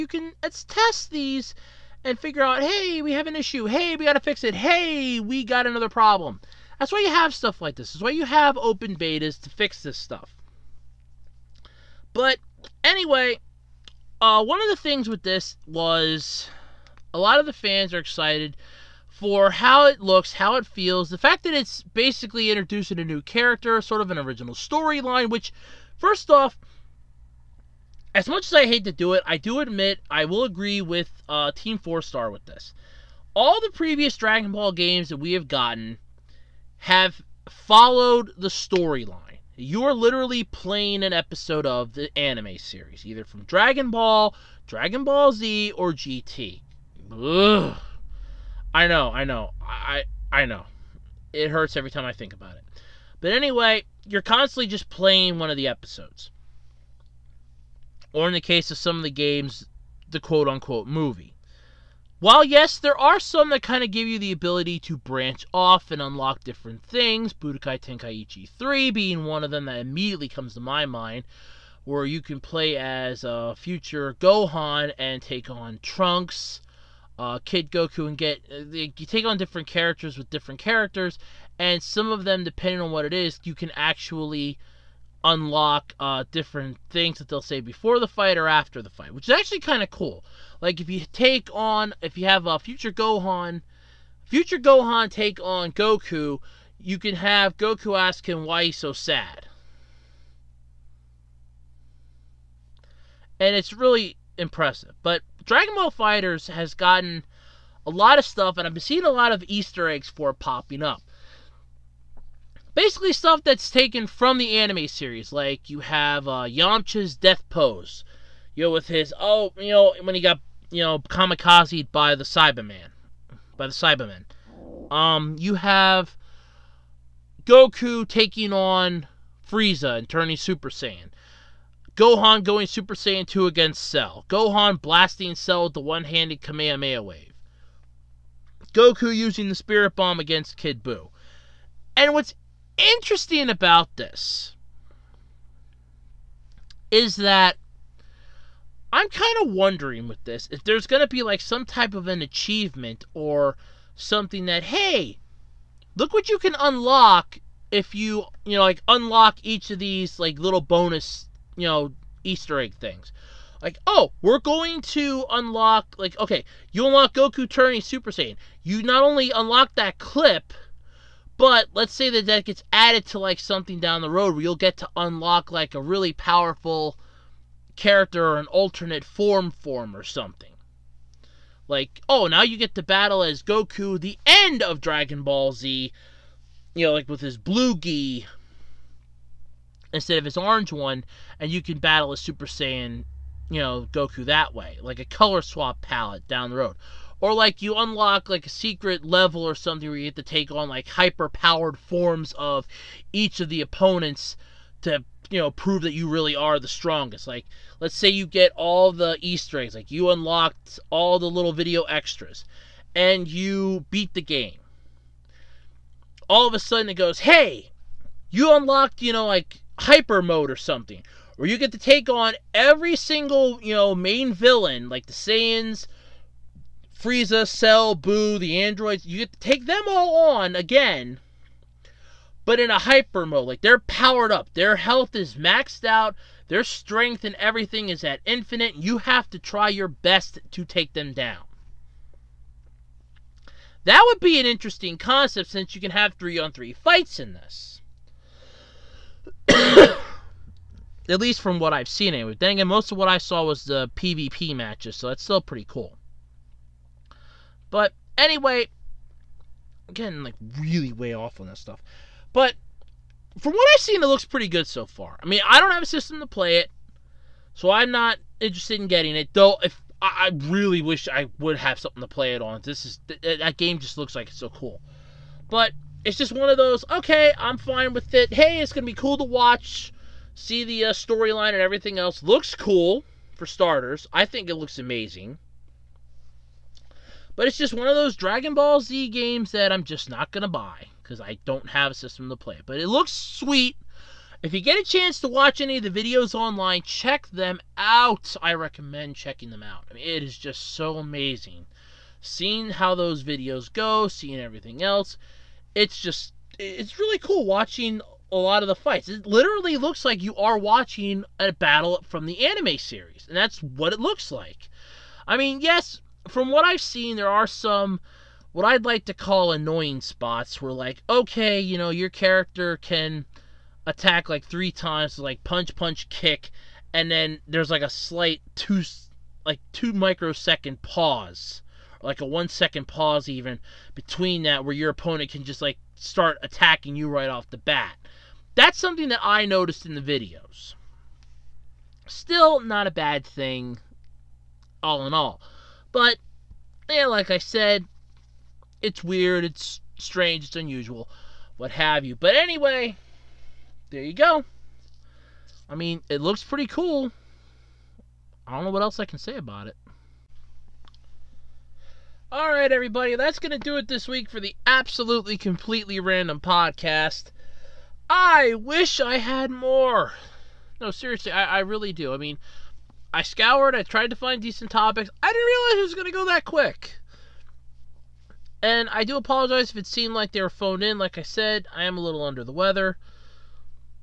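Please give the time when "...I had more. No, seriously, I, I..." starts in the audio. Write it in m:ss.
6:08.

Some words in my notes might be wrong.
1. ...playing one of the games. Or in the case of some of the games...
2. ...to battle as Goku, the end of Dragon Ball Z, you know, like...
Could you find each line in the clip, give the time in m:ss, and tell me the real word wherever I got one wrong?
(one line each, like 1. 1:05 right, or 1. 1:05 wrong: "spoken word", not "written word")
1. 0:54 wrong: "episodes", not "games"
2. 3:02 right.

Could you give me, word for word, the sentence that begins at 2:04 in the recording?
Um, you have Goku taking on Frieza and turning Super Saiyan.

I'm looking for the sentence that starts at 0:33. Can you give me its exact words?
All the previous Dragon Ball games that we have gotten have followed the storyline.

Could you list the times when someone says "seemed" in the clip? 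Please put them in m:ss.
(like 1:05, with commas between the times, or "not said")
6:19.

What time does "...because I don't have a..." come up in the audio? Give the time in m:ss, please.
4:51.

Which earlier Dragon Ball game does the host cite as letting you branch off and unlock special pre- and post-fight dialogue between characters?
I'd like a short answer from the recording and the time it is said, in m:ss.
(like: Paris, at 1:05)
Budokai Tenkaichi 3, at 1:07.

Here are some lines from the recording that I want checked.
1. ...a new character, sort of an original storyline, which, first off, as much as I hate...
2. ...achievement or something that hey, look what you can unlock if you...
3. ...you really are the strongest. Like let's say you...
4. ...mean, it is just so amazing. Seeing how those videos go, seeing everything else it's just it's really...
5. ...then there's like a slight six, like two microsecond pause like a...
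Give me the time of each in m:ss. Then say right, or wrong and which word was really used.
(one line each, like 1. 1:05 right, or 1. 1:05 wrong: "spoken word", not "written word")
1. 0:22 right
2. 2:32 right
3. 3:25 right
4. 4:59 right
5. 5:27 wrong: "two", not "six".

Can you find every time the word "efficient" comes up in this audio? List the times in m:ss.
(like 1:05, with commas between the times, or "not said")
not said.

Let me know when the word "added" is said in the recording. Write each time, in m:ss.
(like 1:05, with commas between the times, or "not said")
2:52.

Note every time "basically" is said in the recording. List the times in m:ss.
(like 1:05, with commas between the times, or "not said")
0:21, 1:52.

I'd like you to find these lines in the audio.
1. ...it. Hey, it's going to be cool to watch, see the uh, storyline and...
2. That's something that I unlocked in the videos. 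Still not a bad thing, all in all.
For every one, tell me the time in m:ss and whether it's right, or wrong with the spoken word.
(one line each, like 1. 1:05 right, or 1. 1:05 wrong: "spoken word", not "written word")
1. 4:38 right
2. 5:38 wrong: "noticed", not "unlocked".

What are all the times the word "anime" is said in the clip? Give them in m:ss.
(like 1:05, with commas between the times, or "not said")
0:42, 1:54, 5:12.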